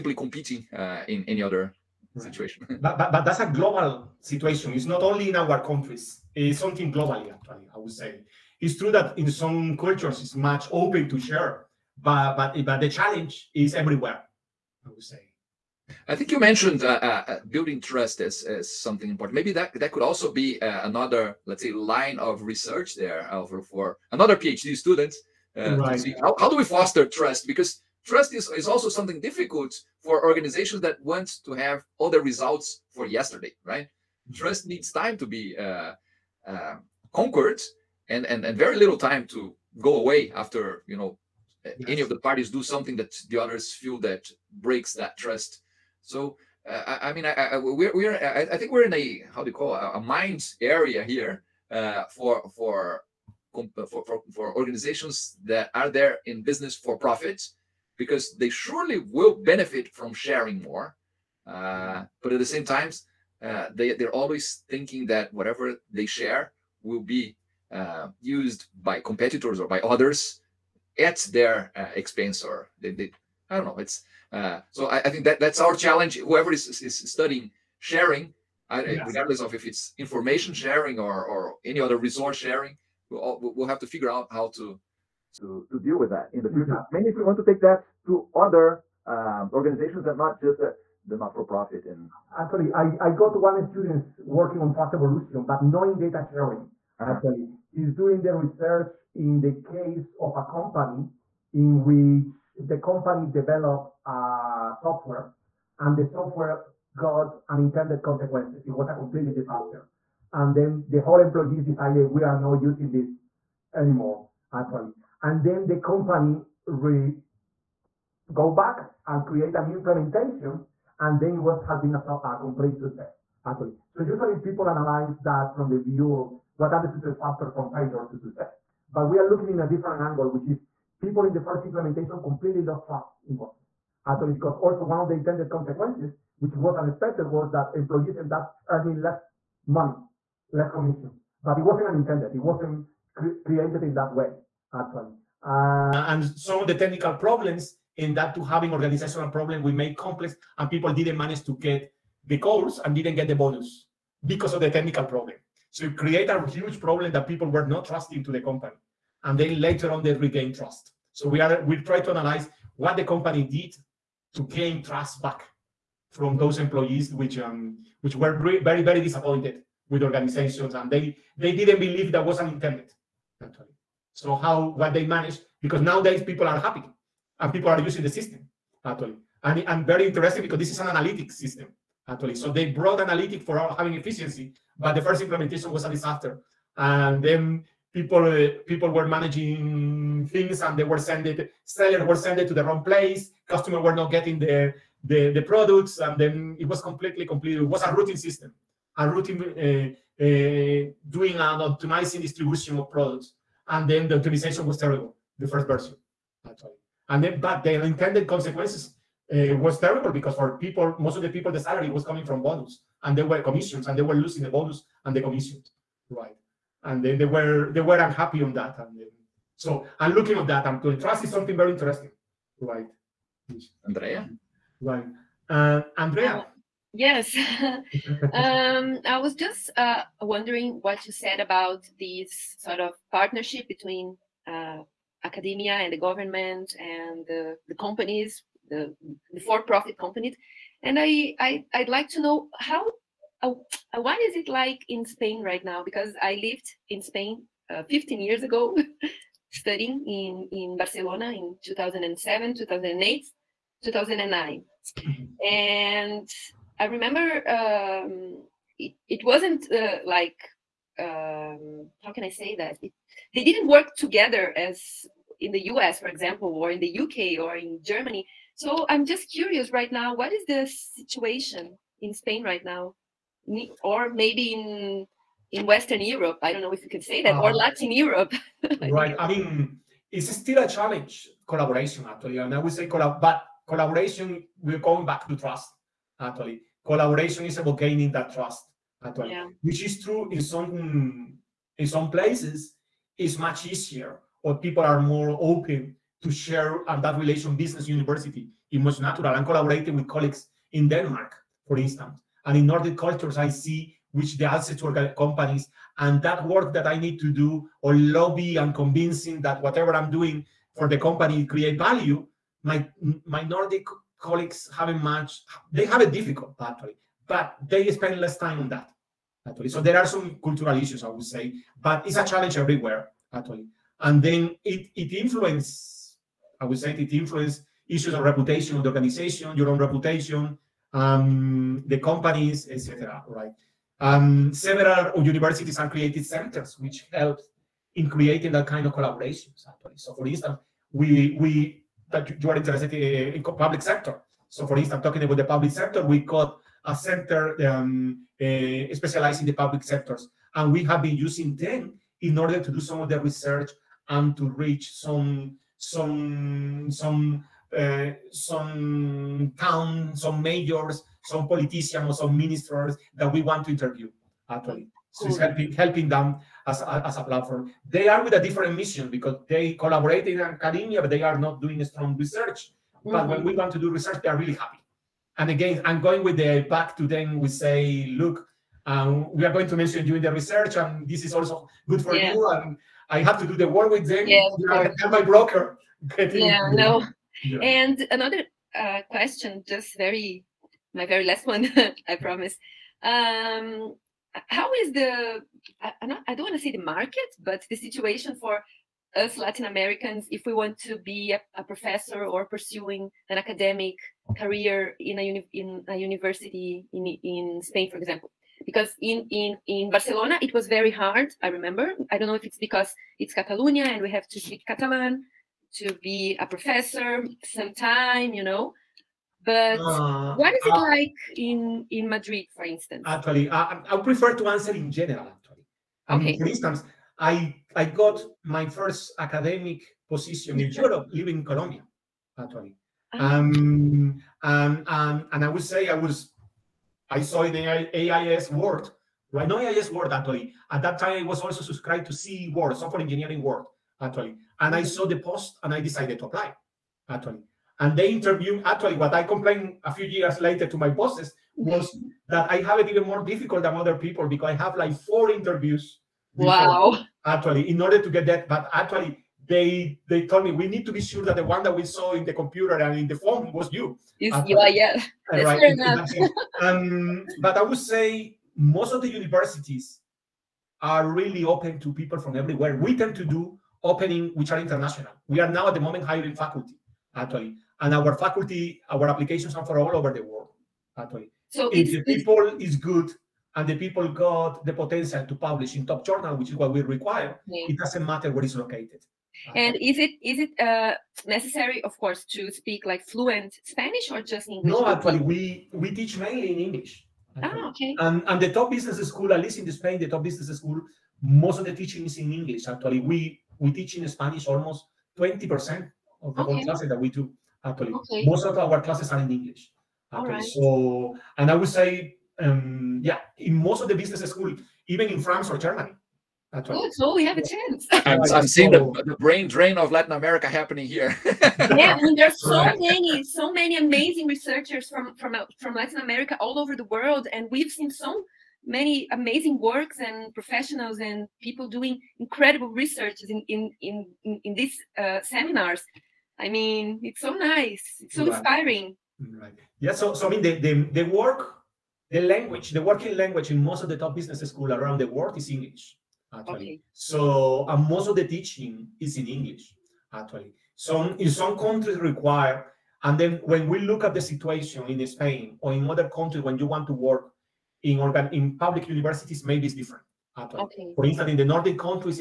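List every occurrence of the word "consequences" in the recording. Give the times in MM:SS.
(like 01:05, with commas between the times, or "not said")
01:48, 02:15, 03:28.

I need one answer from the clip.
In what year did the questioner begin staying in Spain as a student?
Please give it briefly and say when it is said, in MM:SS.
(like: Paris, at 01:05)
2007, at 04:11.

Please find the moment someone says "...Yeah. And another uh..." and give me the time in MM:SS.
06:27.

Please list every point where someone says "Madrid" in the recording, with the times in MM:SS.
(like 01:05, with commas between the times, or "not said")
07:02.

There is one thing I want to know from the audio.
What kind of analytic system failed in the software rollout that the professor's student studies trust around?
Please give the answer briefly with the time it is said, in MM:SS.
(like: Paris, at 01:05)
Routing system, at 03:17.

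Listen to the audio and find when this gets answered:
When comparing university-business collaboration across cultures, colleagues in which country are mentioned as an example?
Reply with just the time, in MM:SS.
05:00.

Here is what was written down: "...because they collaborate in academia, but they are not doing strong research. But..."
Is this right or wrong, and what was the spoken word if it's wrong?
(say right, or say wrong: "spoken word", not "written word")
right.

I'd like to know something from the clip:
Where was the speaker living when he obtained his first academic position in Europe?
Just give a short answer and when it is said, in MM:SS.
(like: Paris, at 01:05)
Colombia, at 07:11.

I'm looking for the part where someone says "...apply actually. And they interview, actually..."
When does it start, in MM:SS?
07:26.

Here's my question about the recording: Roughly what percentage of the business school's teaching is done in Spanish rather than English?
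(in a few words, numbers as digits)
20%.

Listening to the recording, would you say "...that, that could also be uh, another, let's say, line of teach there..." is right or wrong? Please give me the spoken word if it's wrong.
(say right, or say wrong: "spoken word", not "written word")
wrong: "research", not "teach".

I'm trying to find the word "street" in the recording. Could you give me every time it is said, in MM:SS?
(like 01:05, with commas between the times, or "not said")
not said.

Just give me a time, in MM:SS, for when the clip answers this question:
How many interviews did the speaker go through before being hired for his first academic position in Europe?
07:34.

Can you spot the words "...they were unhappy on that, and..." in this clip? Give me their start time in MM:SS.
03:37.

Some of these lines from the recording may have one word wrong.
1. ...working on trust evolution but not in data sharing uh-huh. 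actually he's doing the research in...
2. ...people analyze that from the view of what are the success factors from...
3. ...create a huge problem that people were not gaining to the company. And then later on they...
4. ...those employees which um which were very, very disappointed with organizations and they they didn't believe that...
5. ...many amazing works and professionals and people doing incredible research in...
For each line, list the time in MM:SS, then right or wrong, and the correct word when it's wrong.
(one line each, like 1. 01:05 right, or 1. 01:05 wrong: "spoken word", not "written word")
1. 01:34 right
2. 02:04 right
3. 02:35 wrong: "trusting", not "gaining"
4. 02:46 right
5. 08:48 right.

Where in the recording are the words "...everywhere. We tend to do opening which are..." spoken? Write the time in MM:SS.
07:52.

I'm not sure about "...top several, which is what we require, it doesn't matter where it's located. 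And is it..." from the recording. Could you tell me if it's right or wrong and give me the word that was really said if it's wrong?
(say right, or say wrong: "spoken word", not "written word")
wrong: "journal", not "several".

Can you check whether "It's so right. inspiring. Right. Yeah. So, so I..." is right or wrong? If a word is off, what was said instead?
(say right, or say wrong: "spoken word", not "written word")
right.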